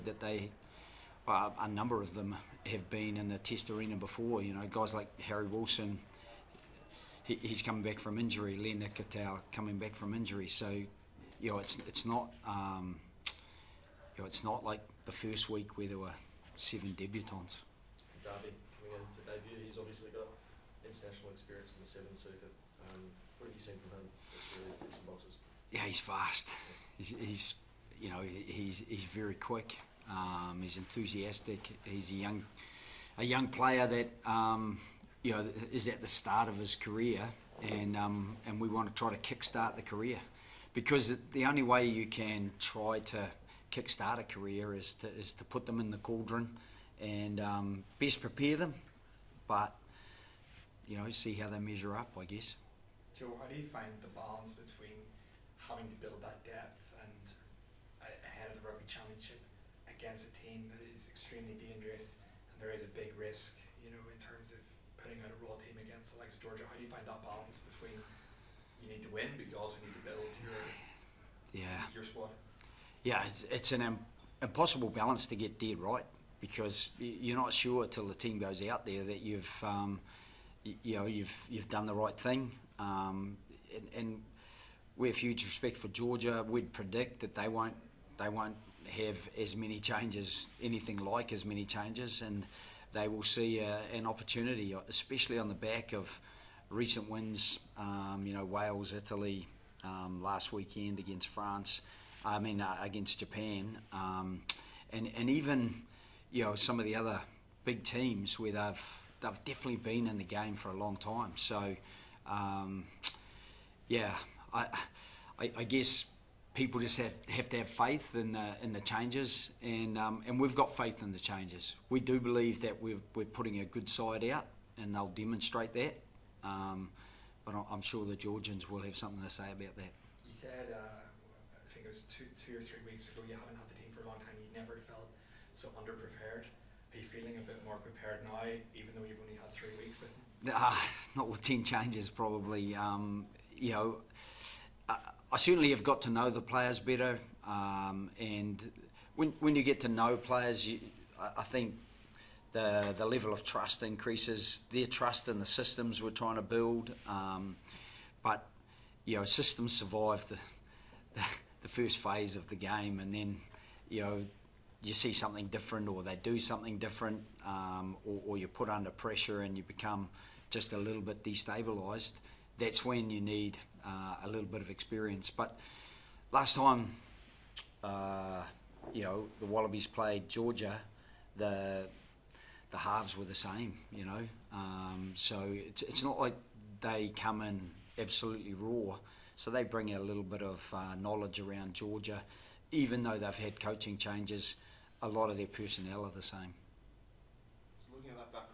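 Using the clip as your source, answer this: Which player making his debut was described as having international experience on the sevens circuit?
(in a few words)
Darby.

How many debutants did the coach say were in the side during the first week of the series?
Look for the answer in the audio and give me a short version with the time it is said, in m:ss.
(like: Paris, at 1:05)
7, at 0:16.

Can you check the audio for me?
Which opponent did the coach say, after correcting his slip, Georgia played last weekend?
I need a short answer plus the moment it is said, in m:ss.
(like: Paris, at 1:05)
Japan, at 1:43.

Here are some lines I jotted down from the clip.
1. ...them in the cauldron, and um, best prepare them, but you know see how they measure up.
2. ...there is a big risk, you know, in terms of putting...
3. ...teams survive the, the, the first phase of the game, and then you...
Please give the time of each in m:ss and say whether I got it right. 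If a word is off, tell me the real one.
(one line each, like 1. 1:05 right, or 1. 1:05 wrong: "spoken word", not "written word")
1. 0:45 right
2. 1:02 right
3. 2:39 wrong: "systems", not "teams".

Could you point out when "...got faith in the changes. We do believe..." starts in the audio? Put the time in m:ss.
2:00.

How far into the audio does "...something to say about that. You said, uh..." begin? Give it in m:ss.
2:08.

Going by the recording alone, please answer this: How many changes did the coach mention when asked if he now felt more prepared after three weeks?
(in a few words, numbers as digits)
10.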